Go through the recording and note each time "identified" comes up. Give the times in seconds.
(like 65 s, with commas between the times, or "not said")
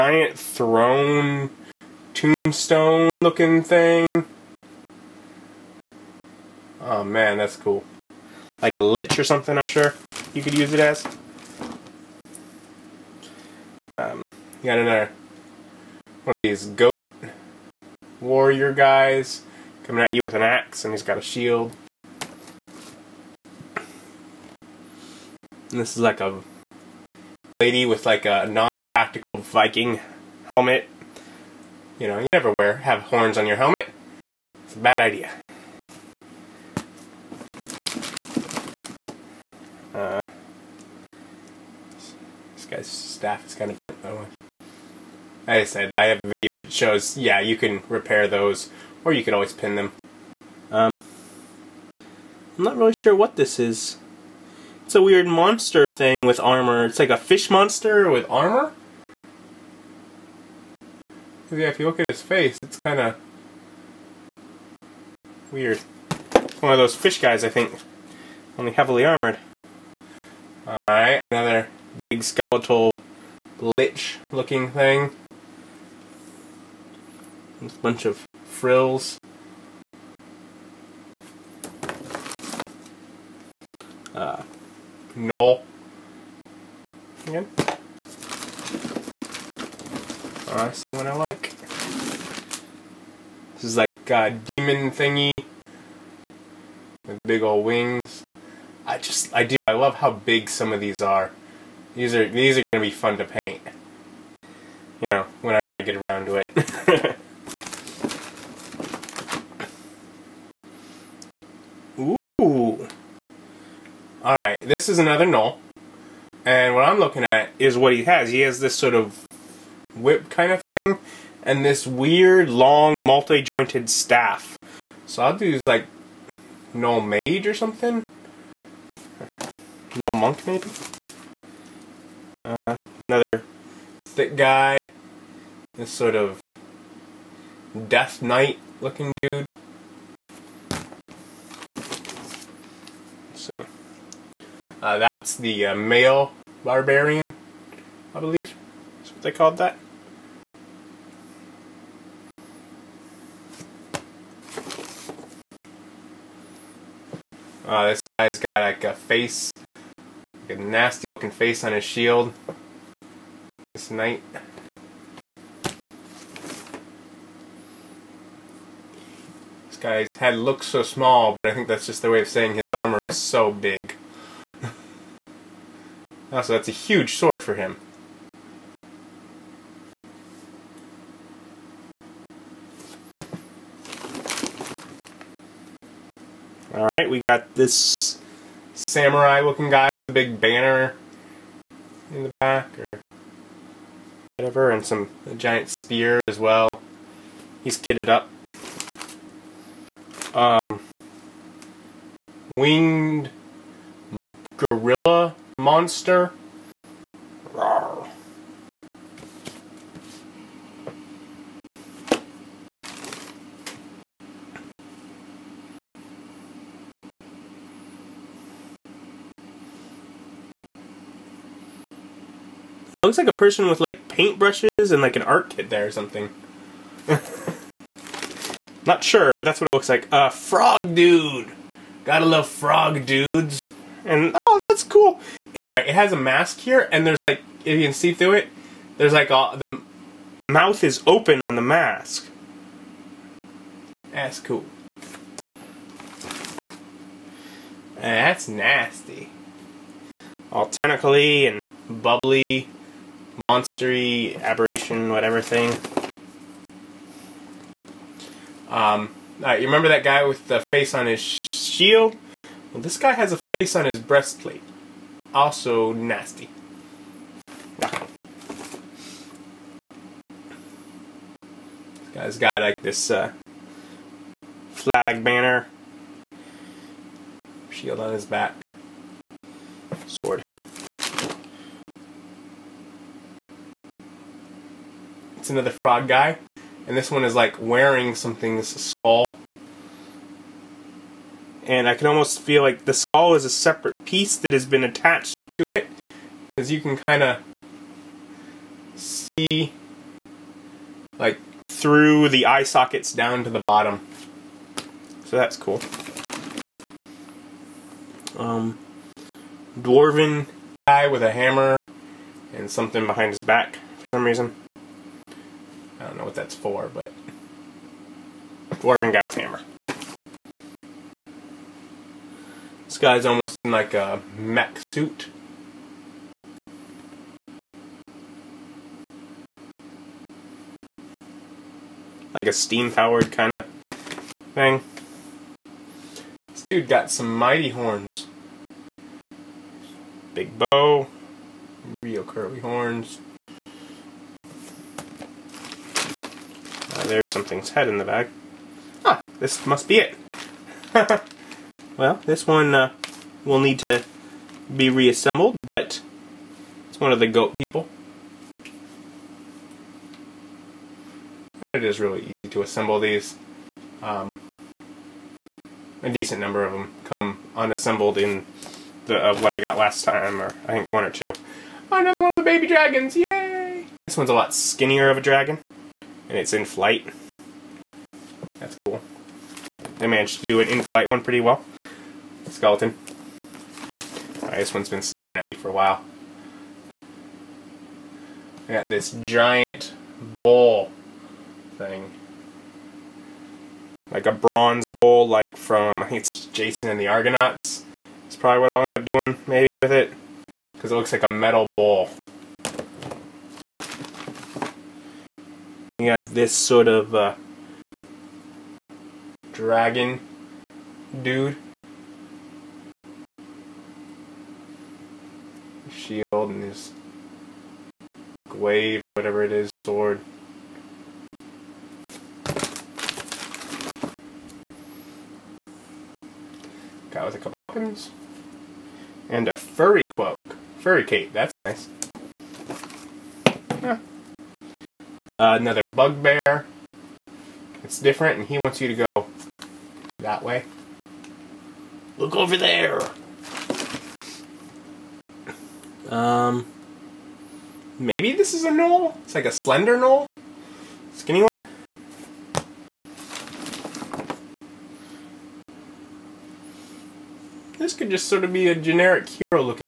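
not said.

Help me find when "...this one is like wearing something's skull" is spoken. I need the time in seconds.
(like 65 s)
286 s.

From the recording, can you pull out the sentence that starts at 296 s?
Because you can kind of see like through the eye sockets down to the bottom.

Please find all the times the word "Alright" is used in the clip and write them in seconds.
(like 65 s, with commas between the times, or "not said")
70 s, 186 s.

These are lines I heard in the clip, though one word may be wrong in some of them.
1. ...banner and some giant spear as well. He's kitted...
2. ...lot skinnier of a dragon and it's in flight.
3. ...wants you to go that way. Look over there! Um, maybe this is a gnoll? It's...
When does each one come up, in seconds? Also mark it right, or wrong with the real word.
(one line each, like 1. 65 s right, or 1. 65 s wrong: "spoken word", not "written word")
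1. 194 s wrong: "whatever", not "banner"
2. 374 s right
3. 438 s right.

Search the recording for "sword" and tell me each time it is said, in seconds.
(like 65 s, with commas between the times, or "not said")
177 s, 280 s, 419 s.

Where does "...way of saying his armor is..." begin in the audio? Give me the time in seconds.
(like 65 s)
172 s.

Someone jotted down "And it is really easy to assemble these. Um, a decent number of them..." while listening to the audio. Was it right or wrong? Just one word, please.
right.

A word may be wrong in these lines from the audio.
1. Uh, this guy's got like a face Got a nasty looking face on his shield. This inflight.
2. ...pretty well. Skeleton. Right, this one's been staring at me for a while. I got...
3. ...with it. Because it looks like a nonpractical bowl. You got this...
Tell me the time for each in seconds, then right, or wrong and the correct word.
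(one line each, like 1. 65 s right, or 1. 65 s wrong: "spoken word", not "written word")
1. 157 s wrong: "knight", not "inflight"
2. 381 s right
3. 399 s wrong: "metal", not "nonpractical".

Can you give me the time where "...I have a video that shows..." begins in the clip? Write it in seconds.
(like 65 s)
45 s.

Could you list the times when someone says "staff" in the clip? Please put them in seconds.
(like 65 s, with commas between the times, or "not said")
42 s, 123 s.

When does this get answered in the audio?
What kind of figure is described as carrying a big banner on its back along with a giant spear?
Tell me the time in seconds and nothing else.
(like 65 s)
188 s.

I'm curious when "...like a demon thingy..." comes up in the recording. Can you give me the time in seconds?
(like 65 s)
93 s.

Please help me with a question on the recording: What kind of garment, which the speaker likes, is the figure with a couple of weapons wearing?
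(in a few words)
Furry cape.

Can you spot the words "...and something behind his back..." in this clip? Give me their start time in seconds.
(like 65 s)
312 s.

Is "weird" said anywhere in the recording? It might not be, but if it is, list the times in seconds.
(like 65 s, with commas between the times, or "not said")
55 s, 65 s, 121 s.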